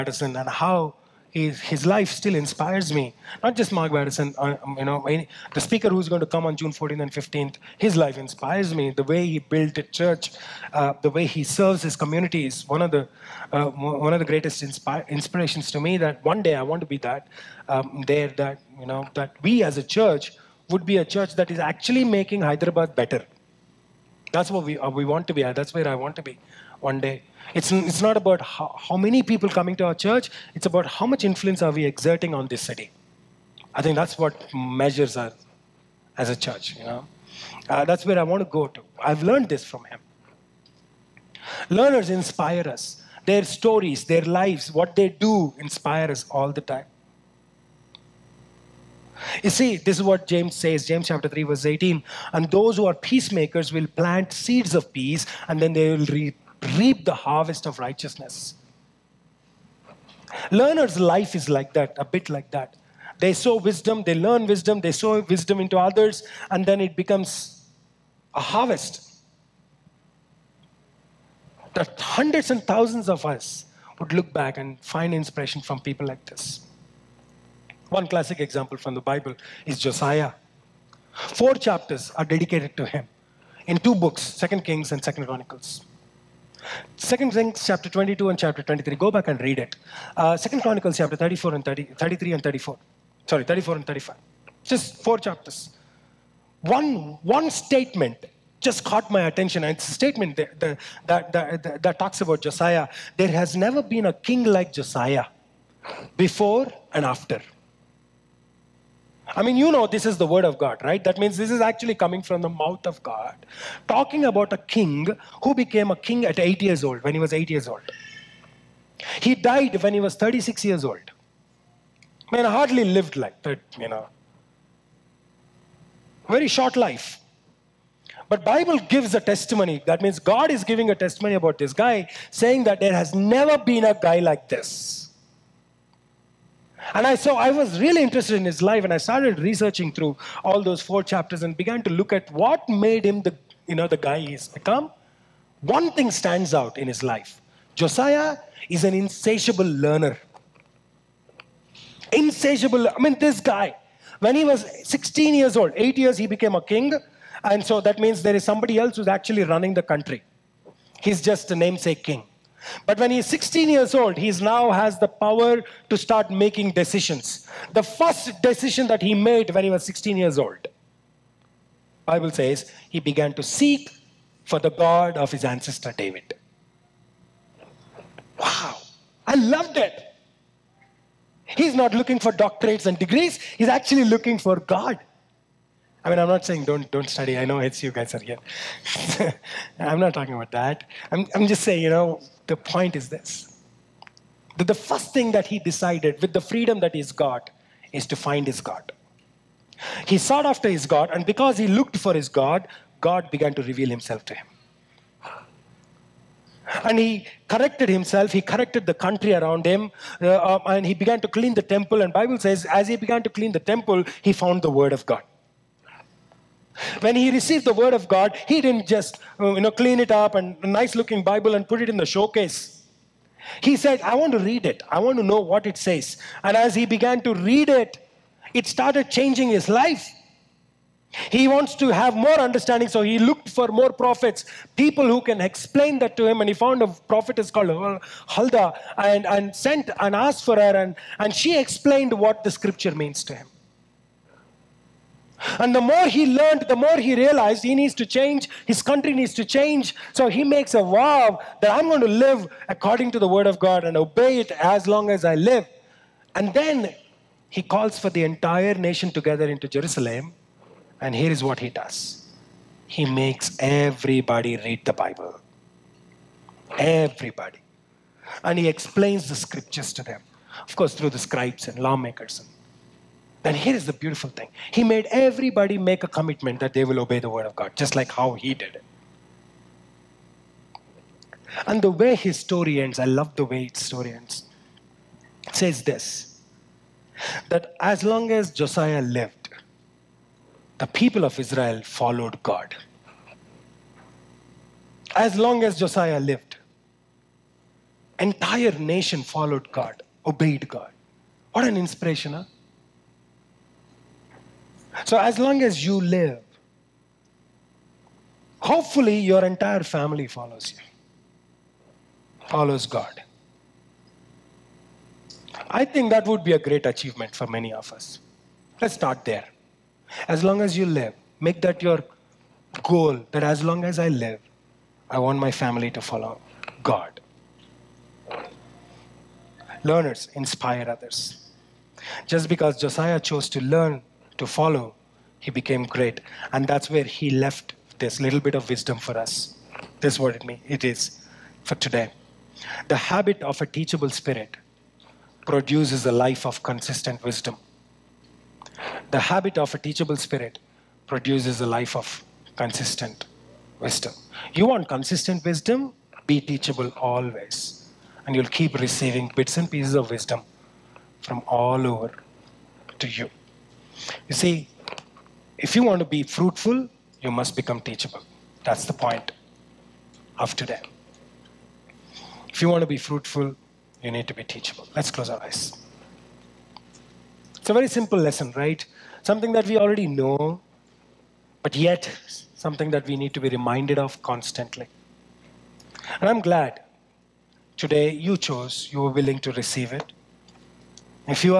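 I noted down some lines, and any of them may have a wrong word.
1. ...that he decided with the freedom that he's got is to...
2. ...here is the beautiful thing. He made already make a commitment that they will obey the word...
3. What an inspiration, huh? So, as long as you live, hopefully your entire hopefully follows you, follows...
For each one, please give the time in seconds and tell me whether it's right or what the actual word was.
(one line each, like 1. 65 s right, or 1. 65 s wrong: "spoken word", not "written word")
1. 195 s right
2. 273 s wrong: "everybody", not "already"
3. 301 s wrong: "family", not "hopefully".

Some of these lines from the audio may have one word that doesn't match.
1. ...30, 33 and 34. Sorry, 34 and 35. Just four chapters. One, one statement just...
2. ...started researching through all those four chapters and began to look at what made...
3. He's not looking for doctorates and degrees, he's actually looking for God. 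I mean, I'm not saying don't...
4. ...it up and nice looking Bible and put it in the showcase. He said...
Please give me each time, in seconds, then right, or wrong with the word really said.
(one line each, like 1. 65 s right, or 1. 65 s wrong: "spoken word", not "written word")
1. 91 s right
2. 138 s right
3. 181 s right
4. 220 s right.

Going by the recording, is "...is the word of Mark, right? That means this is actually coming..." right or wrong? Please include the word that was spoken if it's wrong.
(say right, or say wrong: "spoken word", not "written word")
wrong: "God", not "Mark".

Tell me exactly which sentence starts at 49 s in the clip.
You see, this is what James says, James chapter 3, verse 18.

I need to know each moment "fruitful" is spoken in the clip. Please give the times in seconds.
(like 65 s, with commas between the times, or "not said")
366 s, 372 s.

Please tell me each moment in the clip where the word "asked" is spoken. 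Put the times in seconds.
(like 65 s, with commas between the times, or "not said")
240 s.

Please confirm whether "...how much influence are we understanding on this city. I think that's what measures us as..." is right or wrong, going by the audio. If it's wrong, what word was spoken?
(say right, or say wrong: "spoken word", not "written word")
wrong: "exerting", not "understanding".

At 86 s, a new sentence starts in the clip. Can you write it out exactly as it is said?
Second Kings chapter 22 and chapter 23.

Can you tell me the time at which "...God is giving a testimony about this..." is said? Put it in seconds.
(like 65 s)
130 s.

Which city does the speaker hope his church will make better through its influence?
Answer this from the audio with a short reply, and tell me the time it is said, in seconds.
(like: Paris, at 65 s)
Hyderabad, at 22 s.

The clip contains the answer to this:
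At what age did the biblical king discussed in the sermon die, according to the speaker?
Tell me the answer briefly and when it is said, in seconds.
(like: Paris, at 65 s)
36, at 120 s.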